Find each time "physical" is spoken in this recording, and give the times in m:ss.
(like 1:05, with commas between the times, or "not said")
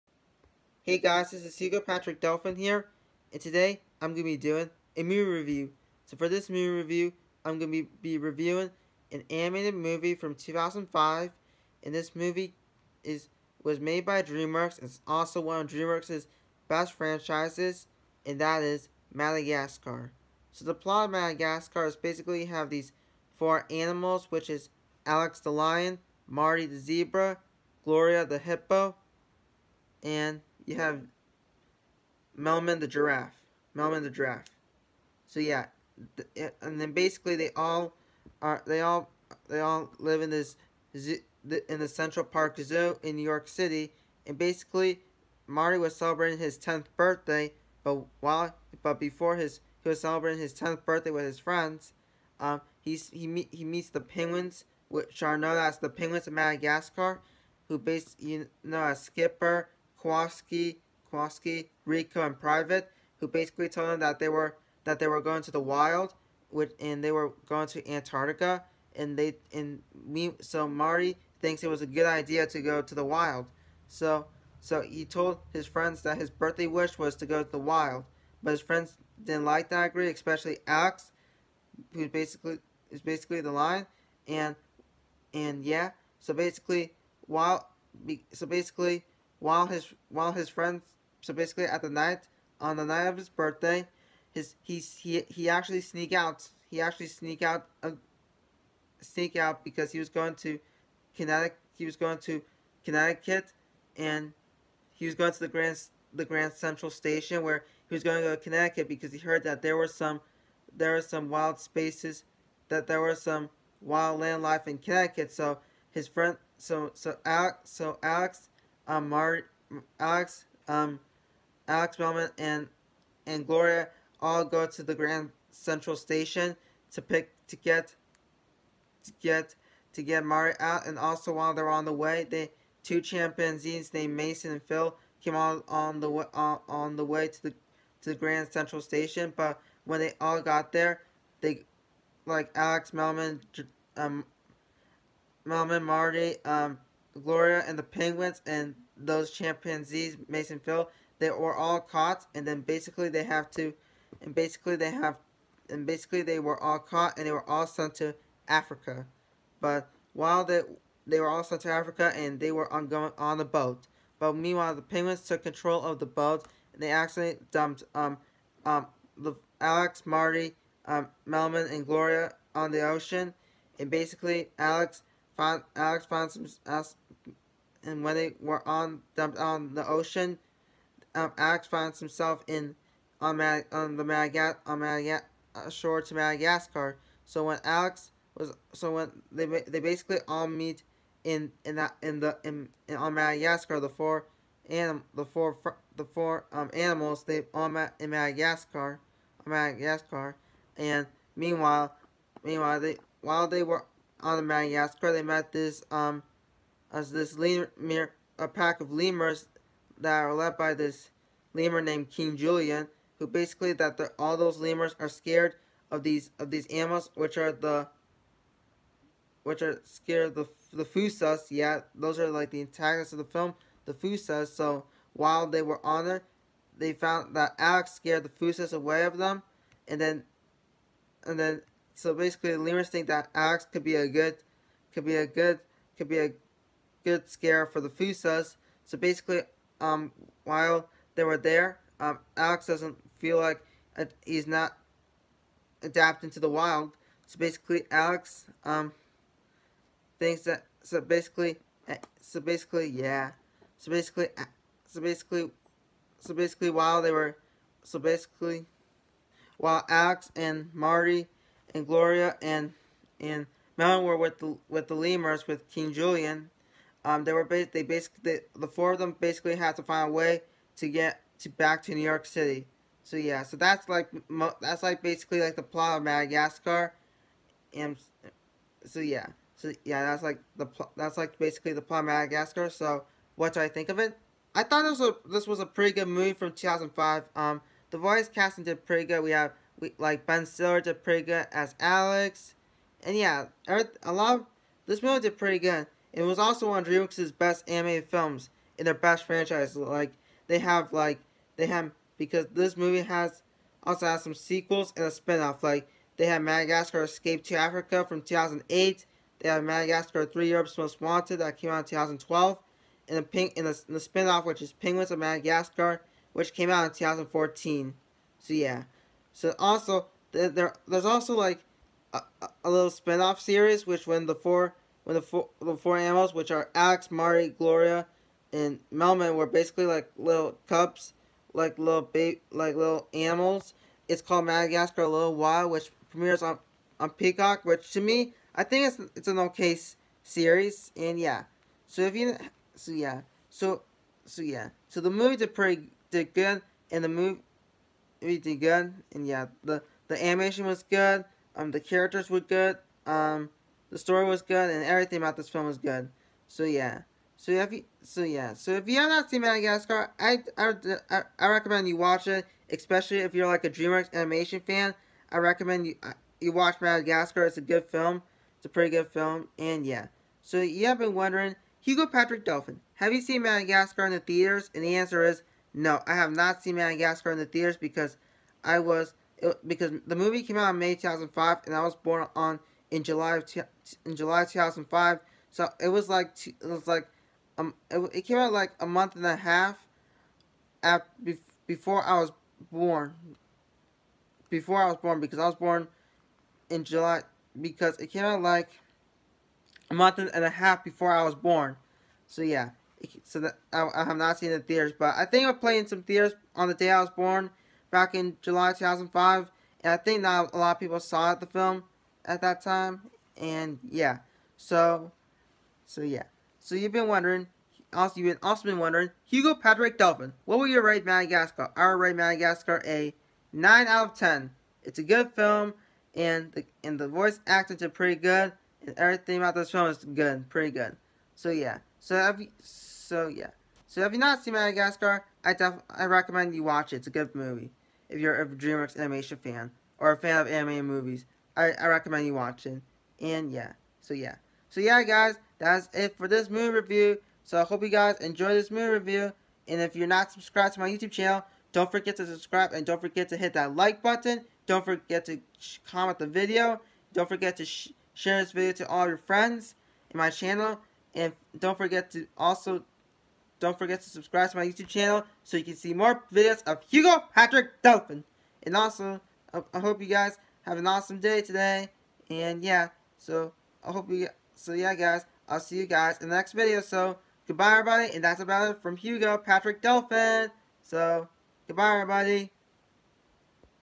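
not said.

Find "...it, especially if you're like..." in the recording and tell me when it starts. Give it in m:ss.
6:02.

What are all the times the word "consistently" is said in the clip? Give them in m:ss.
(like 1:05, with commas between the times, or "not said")
not said.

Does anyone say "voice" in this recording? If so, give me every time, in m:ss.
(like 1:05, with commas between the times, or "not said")
4:47, 7:07.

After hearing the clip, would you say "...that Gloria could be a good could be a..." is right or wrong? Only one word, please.
wrong.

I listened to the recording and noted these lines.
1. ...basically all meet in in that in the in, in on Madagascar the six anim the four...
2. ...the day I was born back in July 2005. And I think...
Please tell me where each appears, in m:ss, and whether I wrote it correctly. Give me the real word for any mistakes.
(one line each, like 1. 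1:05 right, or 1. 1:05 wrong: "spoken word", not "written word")
1. 3:09 wrong: "four", not "six"
2. 6:46 right.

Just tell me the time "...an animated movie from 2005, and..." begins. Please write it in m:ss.
0:09.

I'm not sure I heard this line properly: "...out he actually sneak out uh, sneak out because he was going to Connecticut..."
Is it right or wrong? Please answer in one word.
right.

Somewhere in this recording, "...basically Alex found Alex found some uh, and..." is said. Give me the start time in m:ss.
2:53.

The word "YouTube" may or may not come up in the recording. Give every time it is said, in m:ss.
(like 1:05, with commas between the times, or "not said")
7:30, 7:44.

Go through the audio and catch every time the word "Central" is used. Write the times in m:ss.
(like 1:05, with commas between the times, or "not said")
0:41, 1:46, 2:05, 2:18.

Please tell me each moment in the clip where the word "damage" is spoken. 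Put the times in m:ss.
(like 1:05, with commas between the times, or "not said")
not said.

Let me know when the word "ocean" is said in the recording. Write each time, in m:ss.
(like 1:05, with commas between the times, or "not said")
2:52, 2:59.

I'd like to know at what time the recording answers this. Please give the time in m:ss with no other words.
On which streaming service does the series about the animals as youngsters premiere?
5:37.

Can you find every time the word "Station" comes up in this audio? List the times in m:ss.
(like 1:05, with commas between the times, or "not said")
1:46, 2:05, 2:18.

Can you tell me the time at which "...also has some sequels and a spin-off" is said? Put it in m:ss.
5:03.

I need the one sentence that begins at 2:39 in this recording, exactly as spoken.
But while they they were all sent to Africa, and they were on going on the boat.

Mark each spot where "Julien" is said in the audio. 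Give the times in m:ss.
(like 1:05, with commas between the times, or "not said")
3:32, 4:25.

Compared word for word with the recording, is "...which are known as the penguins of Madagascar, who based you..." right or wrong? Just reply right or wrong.
right.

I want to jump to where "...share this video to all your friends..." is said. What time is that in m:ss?
7:38.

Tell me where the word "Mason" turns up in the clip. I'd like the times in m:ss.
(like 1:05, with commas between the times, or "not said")
2:14, 2:30.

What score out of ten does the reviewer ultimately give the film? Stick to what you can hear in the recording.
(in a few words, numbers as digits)
9 out of 10.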